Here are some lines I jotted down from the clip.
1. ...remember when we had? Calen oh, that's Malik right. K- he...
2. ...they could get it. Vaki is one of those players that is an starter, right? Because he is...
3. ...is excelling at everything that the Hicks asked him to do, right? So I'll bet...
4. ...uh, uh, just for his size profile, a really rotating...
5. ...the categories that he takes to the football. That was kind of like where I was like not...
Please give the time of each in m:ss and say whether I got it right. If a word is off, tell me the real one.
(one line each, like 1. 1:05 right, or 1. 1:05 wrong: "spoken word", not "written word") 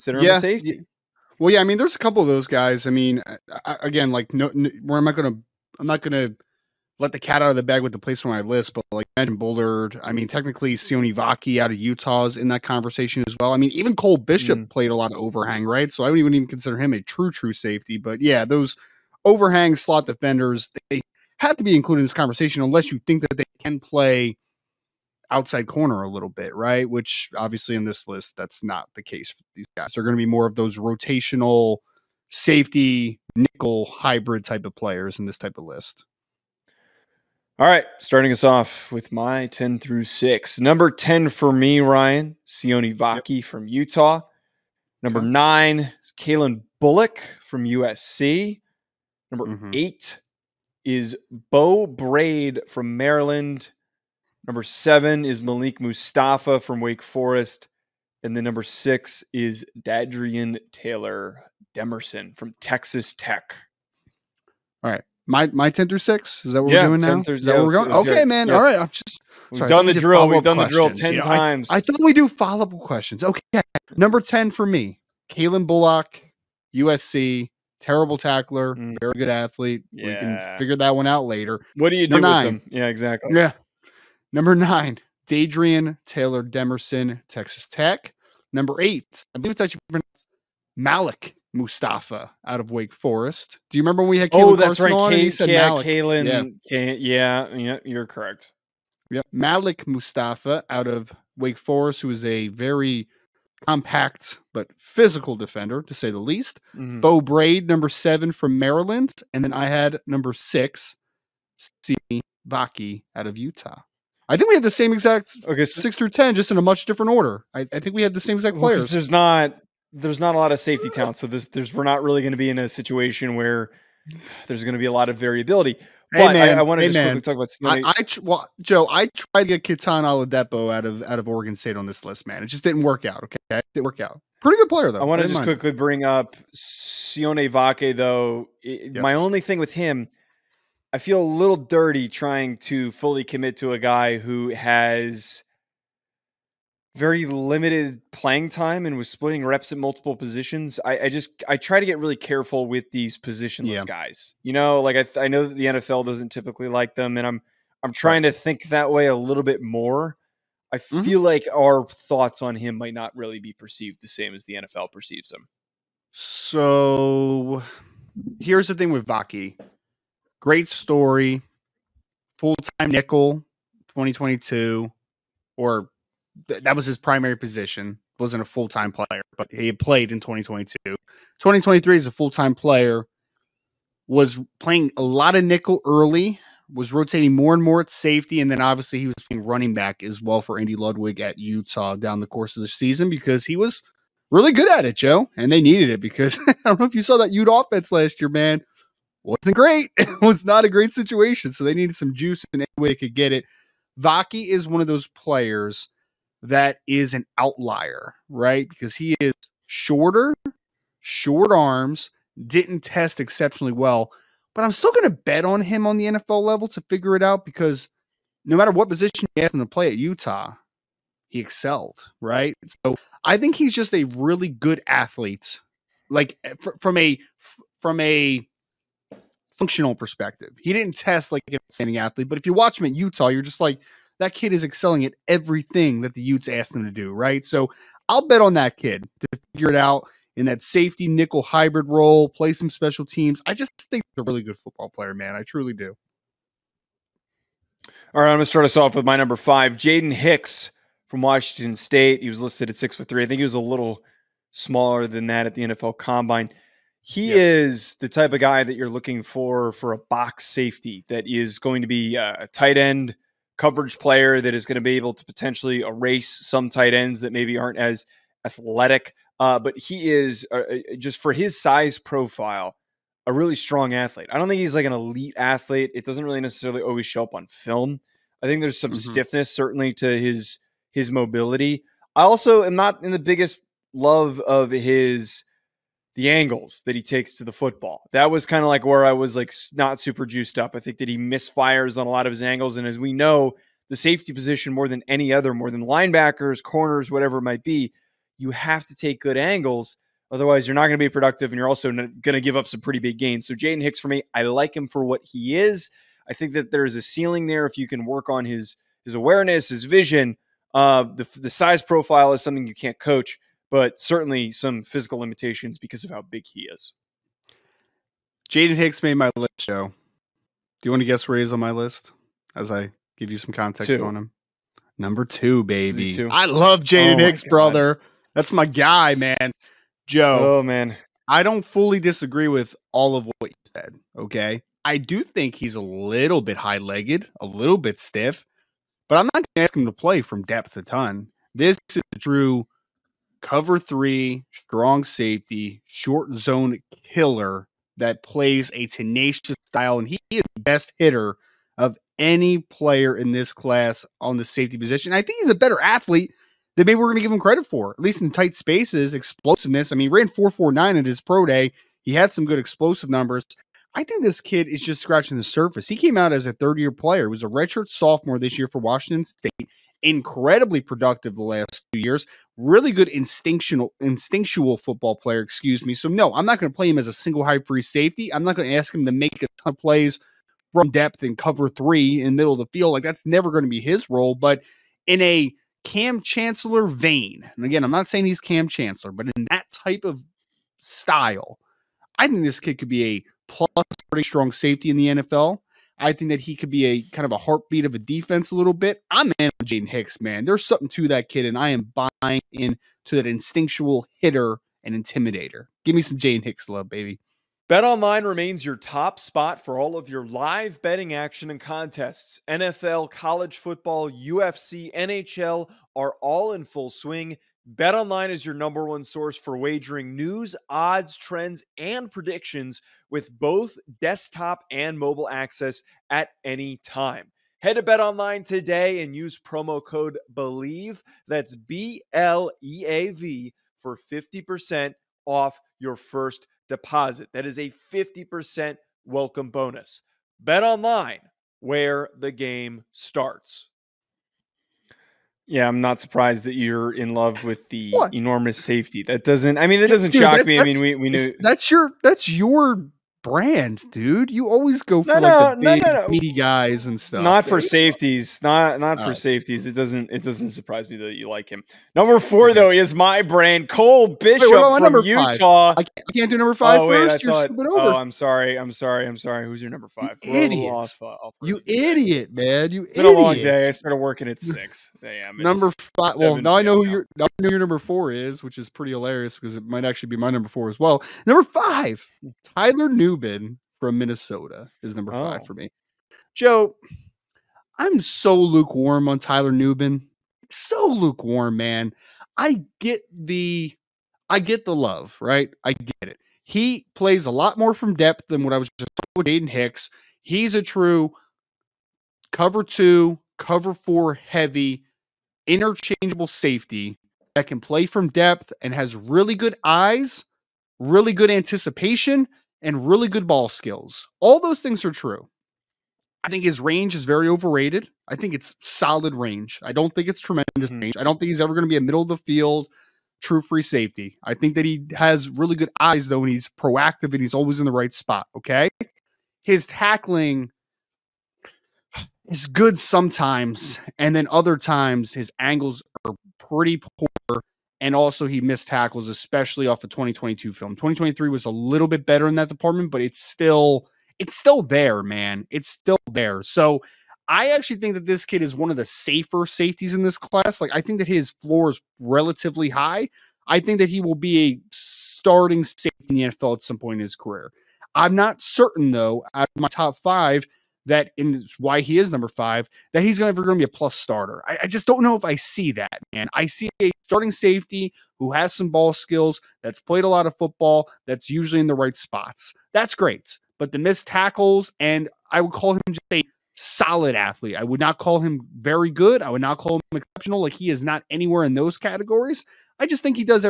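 1. 1:33 wrong: "Carson", not "Malik"
2. 3:22 wrong: "outlier", not "starter"
3. 3:54 wrong: "Utes", not "Hicks"
4. 4:30 wrong: "strong", not "rotating"
5. 4:46 wrong: "angles", not "categories".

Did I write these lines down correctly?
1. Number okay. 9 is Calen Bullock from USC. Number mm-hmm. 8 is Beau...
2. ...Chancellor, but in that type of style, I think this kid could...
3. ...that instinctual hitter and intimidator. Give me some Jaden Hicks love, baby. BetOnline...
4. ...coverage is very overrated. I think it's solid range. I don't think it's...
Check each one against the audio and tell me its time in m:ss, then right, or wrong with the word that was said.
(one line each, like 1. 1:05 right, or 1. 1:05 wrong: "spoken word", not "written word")
1. 0:45 right
2. 6:28 right
3. 6:43 right
4. 8:36 wrong: "range", not "coverage".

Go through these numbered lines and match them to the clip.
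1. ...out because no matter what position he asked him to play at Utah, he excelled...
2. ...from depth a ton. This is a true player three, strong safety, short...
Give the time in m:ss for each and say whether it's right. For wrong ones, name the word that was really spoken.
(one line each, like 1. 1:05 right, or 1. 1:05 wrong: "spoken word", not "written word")
1. 3:37 right
2. 5:40 wrong: "cover", not "player".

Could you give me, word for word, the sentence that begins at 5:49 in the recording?
And he is the best hitter of any player in this class on the safety position.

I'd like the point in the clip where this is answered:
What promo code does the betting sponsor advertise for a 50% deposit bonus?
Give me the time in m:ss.
7:10.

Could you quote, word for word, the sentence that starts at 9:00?
2023 was a little bit better in that department, but it's still it's still there, man.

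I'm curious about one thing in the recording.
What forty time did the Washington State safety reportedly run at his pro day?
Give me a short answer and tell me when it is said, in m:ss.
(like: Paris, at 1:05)
4.49, at 6:00.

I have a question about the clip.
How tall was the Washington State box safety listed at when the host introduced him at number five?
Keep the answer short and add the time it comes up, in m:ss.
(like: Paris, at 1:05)
6 foot 3, at 4:12.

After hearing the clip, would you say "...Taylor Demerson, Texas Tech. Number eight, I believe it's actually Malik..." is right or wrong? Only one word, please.
right.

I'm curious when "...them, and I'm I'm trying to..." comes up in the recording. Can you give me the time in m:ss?
2:36.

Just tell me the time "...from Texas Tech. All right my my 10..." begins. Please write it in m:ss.
1:02.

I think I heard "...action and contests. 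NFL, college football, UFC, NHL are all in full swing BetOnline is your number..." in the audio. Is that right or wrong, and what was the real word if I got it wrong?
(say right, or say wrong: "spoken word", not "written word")
right.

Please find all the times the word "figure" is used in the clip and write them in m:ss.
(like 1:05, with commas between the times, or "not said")
1:20, 3:36, 3:59.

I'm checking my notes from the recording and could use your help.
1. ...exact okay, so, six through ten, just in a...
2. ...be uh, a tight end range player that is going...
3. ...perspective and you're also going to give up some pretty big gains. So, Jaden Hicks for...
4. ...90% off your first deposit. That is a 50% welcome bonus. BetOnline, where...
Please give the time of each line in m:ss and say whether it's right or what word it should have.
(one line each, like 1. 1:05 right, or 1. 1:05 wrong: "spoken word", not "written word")
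1. 1:54 right
2. 4:21 wrong: "coverage", not "range"
3. 5:01 wrong: "productive", not "perspective"
4. 7:14 wrong: "50", not "90".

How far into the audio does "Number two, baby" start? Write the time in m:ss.
5:24.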